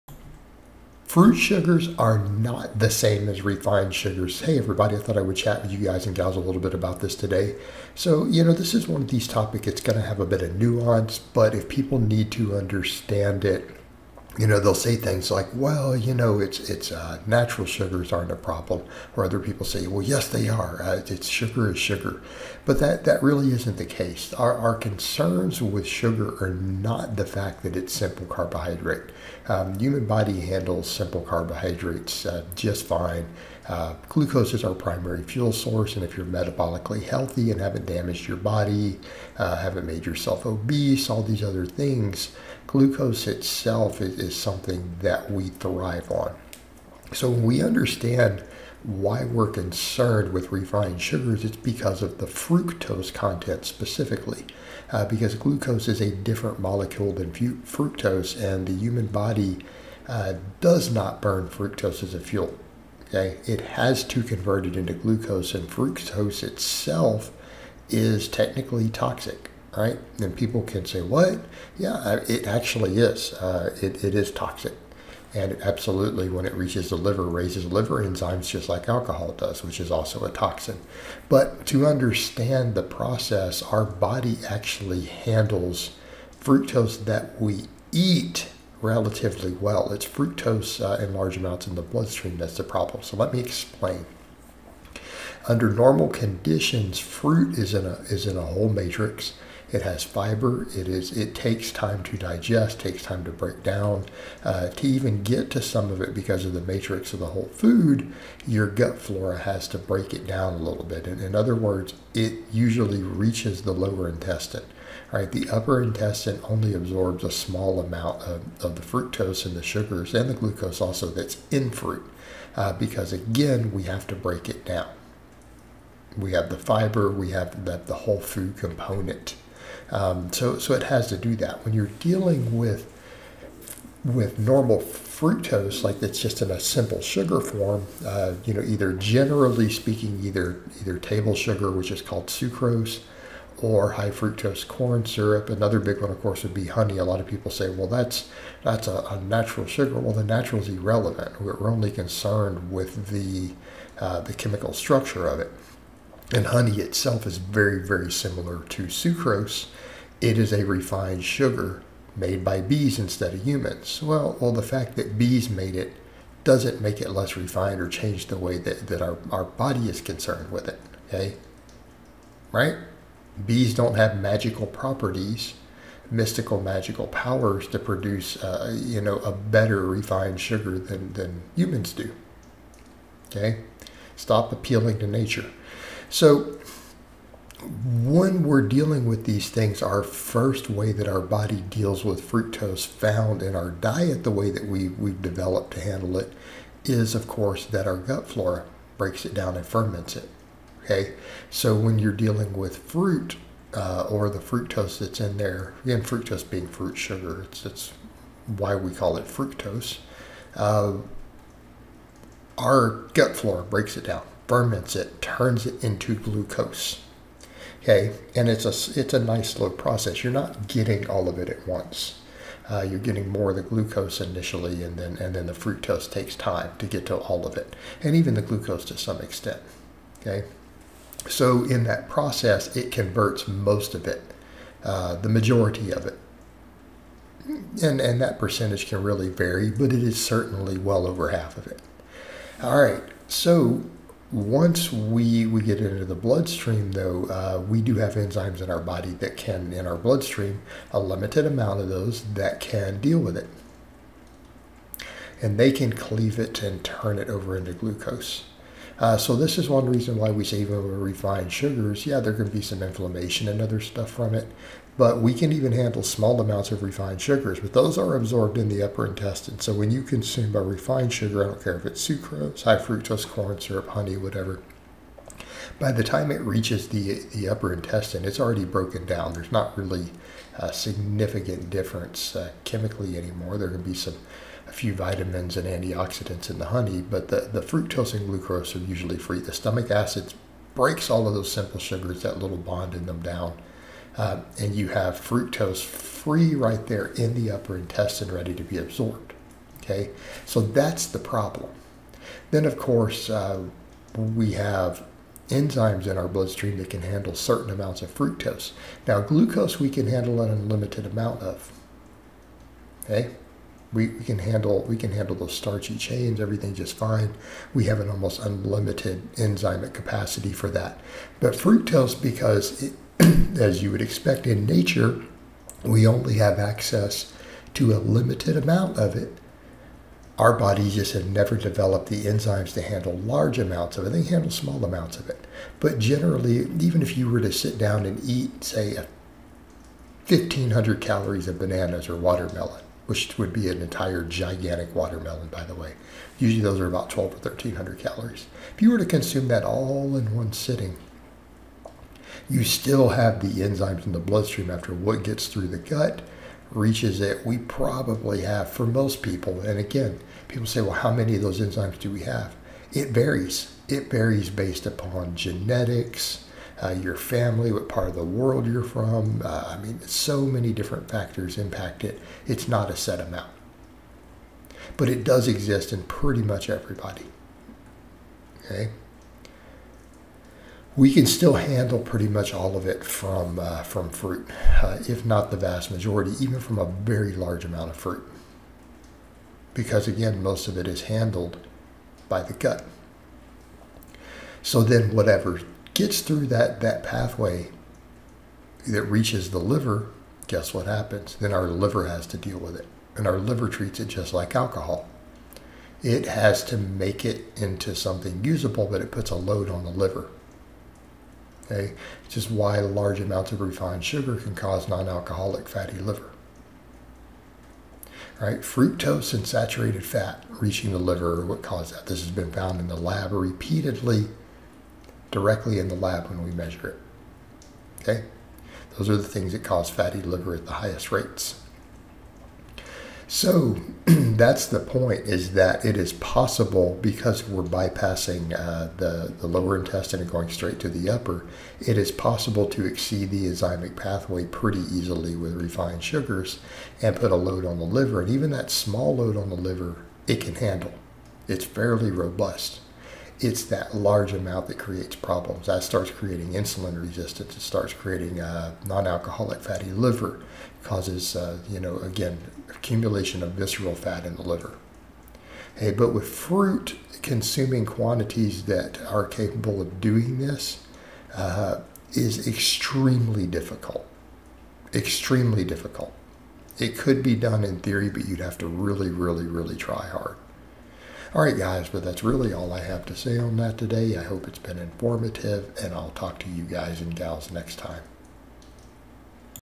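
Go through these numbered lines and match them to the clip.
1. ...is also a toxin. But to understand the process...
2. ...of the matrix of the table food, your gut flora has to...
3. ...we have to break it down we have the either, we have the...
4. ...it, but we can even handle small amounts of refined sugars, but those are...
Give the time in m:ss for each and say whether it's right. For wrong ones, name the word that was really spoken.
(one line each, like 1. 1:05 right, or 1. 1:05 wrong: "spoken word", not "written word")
1. 1:19 right
2. 1:46 wrong: "whole", not "table"
3. 2:03 wrong: "fiber", not "either"
4. 4:24 right.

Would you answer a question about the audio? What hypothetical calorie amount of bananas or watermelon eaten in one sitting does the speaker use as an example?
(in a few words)
1500.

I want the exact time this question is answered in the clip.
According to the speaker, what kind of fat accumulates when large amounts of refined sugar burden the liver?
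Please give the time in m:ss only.
7:43.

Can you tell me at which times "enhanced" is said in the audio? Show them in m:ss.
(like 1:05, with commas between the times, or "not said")
not said.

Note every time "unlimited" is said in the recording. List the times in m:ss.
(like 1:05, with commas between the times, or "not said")
5:10, 5:18.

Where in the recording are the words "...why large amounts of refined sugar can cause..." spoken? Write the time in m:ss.
6:52.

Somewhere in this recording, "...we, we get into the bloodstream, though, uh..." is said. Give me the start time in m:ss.
4:04.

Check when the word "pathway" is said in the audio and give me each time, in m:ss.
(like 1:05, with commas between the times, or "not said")
6:37, 7:23.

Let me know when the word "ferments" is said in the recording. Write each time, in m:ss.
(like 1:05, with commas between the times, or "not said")
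3:19, 3:34.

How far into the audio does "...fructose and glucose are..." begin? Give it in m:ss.
4:47.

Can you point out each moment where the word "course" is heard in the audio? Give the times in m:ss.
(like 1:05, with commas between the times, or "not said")
2:26, 3:17, 5:02.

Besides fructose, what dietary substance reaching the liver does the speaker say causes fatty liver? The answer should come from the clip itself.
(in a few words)
saturated fat.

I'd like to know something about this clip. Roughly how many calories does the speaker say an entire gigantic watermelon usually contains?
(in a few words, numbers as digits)
1200 or 1300.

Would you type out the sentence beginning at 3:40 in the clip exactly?
You're not getting all of it at once.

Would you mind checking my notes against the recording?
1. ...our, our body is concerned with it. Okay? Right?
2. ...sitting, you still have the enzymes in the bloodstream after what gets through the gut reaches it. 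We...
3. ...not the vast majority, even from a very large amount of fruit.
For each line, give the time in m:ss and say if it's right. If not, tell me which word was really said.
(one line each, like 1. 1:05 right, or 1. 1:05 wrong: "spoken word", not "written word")
1. 2:49 right
2. 5:50 right
3. 6:25 right.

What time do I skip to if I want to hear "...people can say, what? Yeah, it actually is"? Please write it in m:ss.
1:10.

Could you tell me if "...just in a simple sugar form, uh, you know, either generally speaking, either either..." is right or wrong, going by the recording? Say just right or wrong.
right.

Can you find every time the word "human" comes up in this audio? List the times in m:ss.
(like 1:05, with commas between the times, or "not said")
0:29, 0:58, 2:43, 3:01.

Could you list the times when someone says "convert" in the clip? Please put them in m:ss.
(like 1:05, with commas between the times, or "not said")
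1:04, 3:52.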